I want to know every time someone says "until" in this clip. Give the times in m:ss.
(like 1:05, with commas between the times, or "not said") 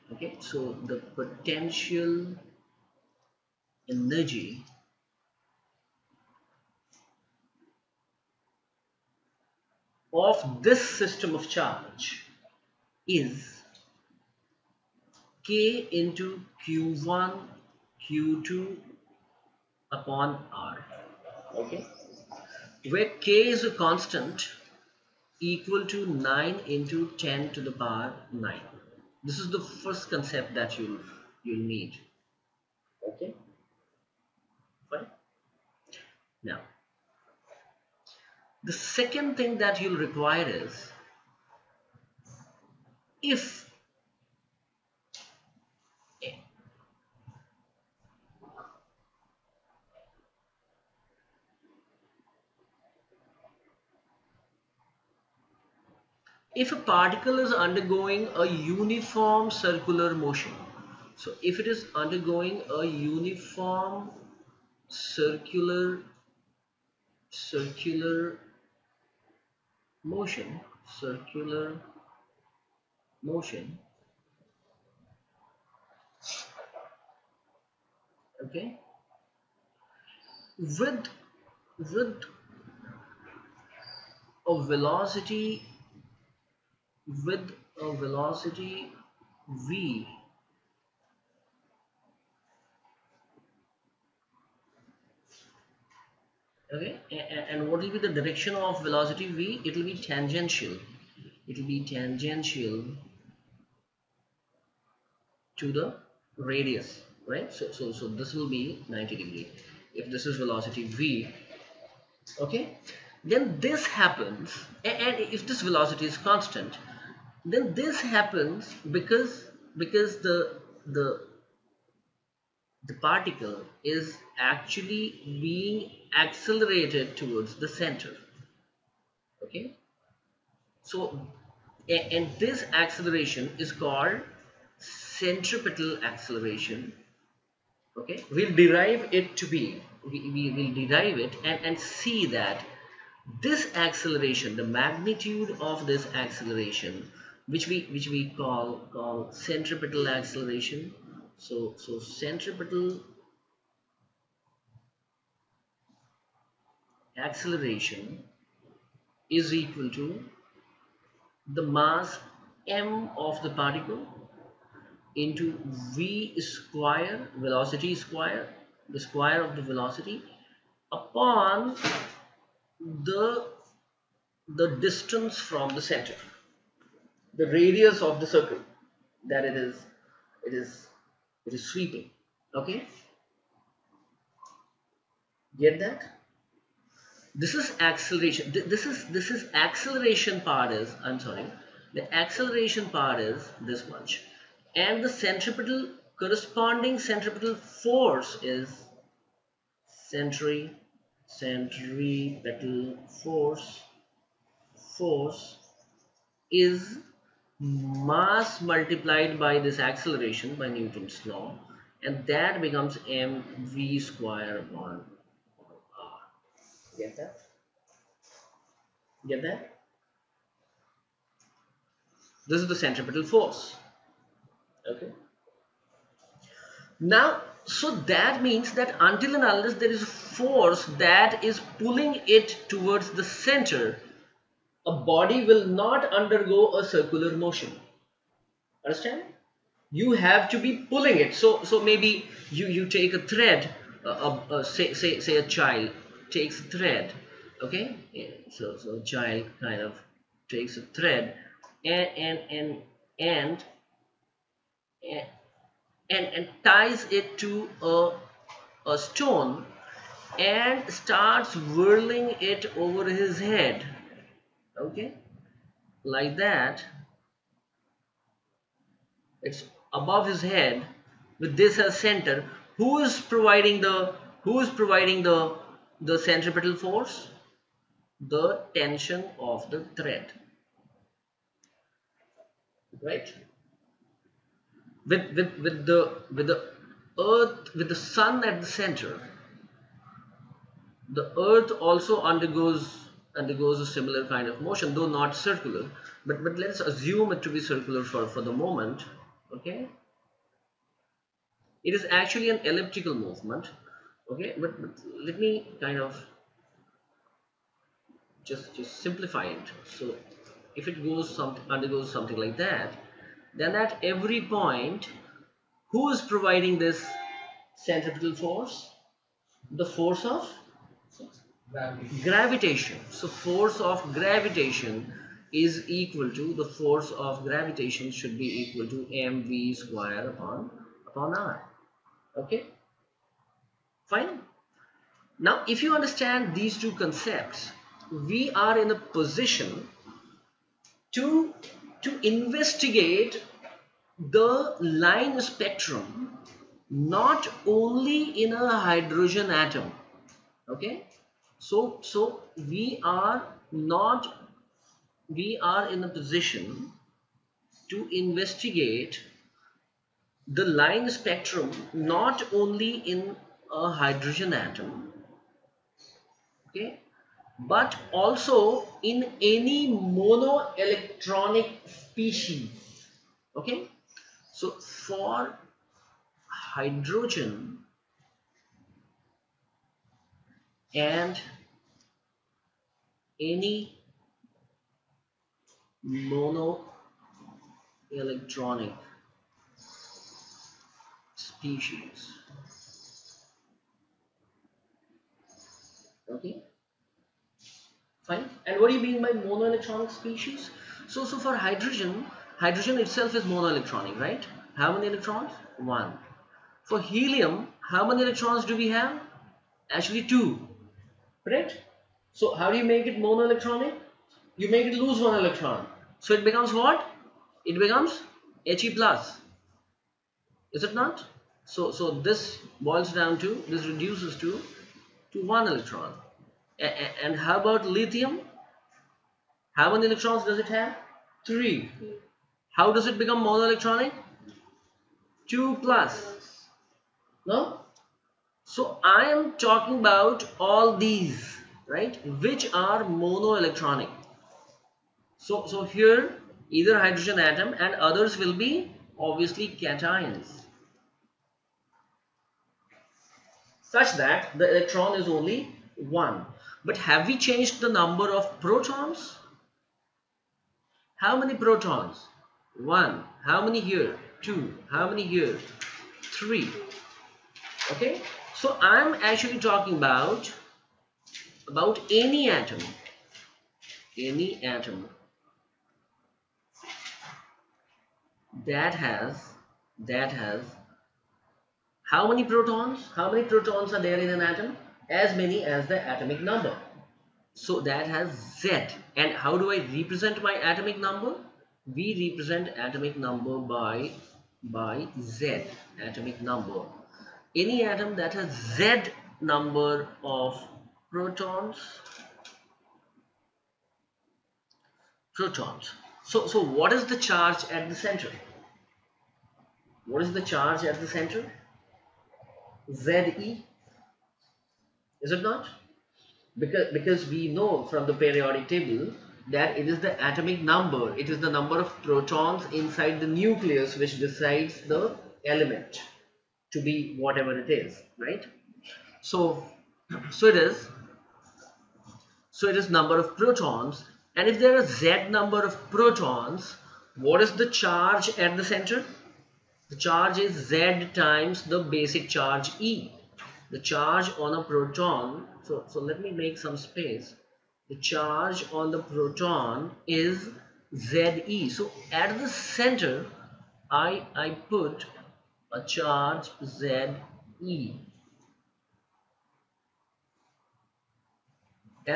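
3:48.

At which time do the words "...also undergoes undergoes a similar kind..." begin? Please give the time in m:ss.
4:51.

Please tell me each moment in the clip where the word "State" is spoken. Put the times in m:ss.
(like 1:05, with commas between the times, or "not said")
not said.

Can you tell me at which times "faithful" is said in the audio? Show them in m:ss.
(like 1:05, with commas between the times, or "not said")
not said.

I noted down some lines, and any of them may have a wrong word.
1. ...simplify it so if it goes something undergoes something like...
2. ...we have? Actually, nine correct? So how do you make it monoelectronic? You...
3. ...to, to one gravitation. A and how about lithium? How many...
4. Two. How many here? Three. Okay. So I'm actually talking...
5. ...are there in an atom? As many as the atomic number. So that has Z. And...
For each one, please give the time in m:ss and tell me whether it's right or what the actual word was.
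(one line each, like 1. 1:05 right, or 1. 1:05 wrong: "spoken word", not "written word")
1. 5:08 right
2. 6:48 wrong: "two", not "nine"
3. 7:04 wrong: "electron", not "gravitation"
4. 7:44 right
5. 8:03 right.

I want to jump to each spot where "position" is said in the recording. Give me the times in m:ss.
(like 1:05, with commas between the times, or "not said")
5:39, 5:56.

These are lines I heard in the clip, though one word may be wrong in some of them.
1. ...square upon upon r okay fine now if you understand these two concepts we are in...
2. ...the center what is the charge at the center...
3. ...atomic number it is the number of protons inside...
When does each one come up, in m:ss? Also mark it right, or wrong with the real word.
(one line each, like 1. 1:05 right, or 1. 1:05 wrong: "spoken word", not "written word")
1. 5:29 right
2. 8:27 right
3. 8:40 right.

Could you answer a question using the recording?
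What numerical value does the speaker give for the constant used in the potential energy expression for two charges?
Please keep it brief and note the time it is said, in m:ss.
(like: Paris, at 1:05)
9 x 10^9, at 0:26.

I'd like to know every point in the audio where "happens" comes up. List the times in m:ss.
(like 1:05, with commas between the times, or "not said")
1:53, 1:57.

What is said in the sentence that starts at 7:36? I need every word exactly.
But have we changed the number of protons?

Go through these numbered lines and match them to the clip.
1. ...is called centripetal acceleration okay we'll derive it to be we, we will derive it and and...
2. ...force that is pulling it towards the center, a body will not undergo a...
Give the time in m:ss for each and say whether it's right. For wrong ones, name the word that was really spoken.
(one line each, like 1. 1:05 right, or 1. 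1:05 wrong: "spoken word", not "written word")
1. 2:13 right
2. 3:50 right.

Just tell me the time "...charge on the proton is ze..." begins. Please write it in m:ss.
9:08.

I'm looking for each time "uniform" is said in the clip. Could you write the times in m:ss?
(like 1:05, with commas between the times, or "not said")
0:58, 1:02.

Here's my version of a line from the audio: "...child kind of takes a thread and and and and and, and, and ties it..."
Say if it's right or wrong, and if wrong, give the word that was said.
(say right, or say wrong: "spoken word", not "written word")
right.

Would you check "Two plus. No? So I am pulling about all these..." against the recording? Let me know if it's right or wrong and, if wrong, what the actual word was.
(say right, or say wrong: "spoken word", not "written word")
wrong: "talking", not "pulling".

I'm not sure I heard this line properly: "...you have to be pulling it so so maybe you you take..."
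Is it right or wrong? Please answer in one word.
right.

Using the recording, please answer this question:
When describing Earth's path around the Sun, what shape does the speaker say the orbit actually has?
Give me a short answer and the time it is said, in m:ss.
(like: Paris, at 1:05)
elliptical, at 5:02.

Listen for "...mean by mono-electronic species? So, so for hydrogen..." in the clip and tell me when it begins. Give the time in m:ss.
6:39.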